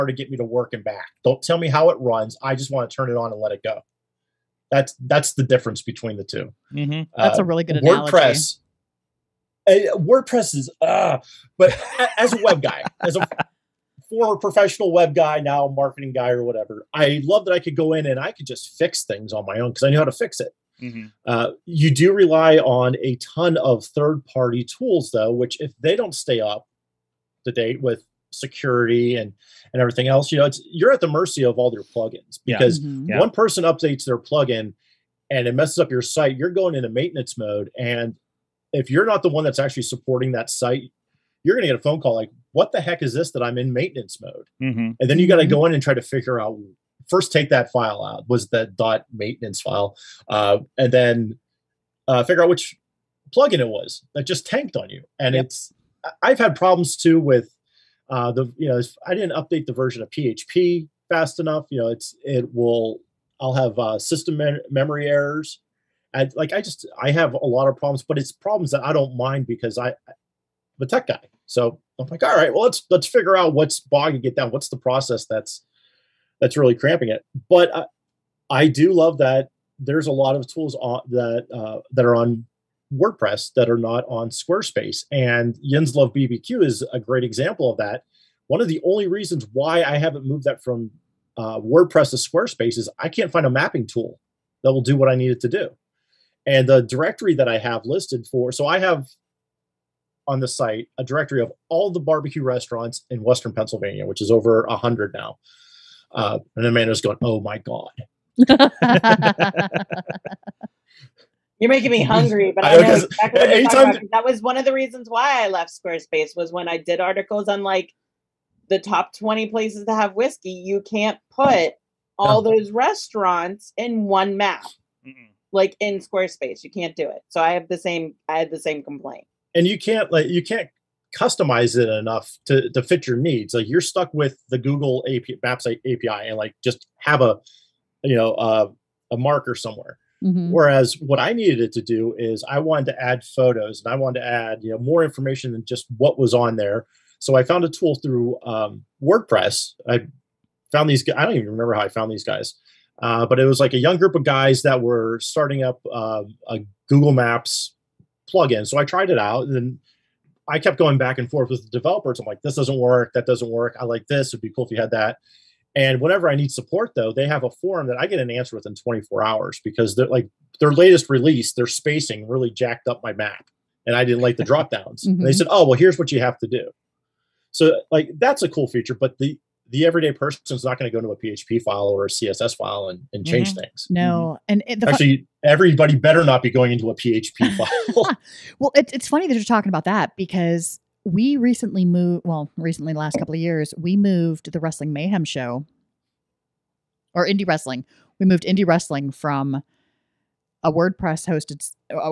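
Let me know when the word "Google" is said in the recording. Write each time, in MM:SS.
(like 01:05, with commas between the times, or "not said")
02:14, 02:36.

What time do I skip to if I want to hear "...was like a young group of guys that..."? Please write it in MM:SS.
02:33.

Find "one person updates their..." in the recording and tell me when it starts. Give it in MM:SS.
00:33.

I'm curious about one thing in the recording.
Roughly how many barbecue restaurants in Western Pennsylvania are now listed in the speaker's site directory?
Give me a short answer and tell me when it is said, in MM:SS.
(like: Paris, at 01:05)
Over 100, at 01:44.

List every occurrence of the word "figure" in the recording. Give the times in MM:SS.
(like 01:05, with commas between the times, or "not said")
00:46, 00:52, 01:13.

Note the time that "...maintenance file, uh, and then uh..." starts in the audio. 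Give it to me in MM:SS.
00:49.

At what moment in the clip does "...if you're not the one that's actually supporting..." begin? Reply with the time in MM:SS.
00:38.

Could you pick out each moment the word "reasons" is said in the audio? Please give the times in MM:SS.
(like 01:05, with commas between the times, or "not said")
01:29, 01:54.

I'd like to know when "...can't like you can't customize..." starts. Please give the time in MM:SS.
02:09.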